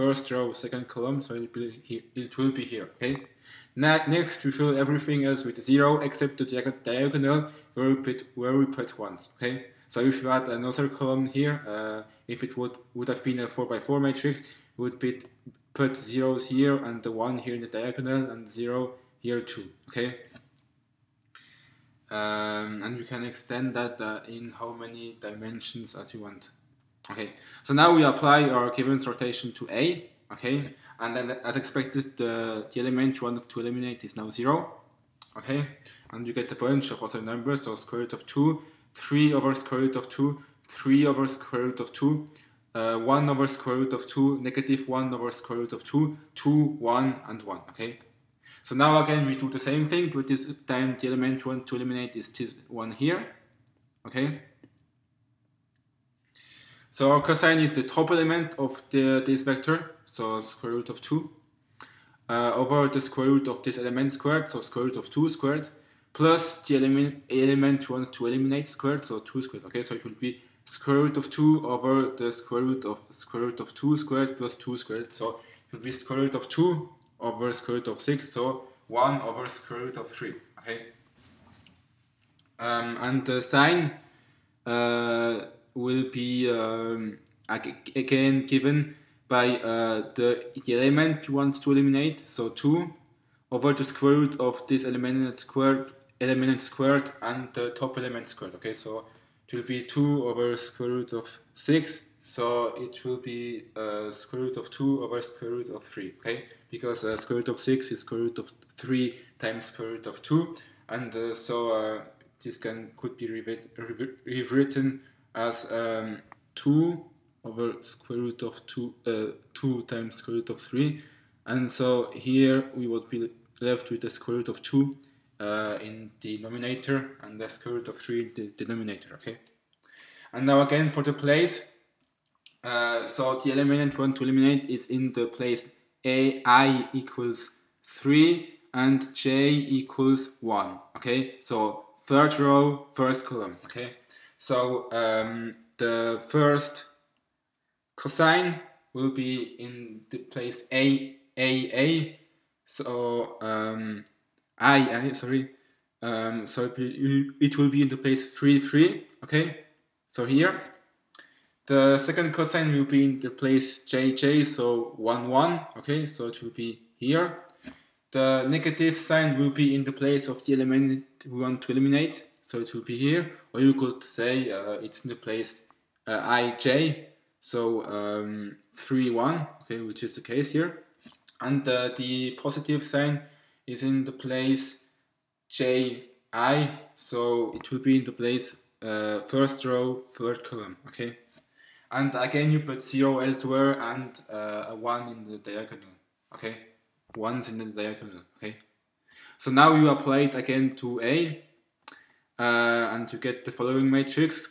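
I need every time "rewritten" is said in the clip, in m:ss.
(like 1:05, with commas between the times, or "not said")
1:54.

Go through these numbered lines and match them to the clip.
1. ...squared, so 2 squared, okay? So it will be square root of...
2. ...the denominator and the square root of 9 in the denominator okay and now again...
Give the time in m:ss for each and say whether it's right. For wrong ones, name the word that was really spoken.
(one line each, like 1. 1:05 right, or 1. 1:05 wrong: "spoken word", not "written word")
1. 1:08 right
2. 2:06 wrong: "3", not "9".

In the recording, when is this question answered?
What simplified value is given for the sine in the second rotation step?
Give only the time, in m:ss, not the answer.
1:44.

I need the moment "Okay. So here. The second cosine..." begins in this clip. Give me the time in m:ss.
2:39.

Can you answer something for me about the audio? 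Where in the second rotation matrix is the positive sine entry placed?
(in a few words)
first row third column.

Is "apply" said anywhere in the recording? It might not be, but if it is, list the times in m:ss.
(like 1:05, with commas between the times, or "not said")
0:28, 3:19.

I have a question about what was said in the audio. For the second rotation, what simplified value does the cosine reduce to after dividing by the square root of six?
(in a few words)
1 over square root of 3.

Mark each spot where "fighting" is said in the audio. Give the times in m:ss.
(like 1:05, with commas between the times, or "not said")
not said.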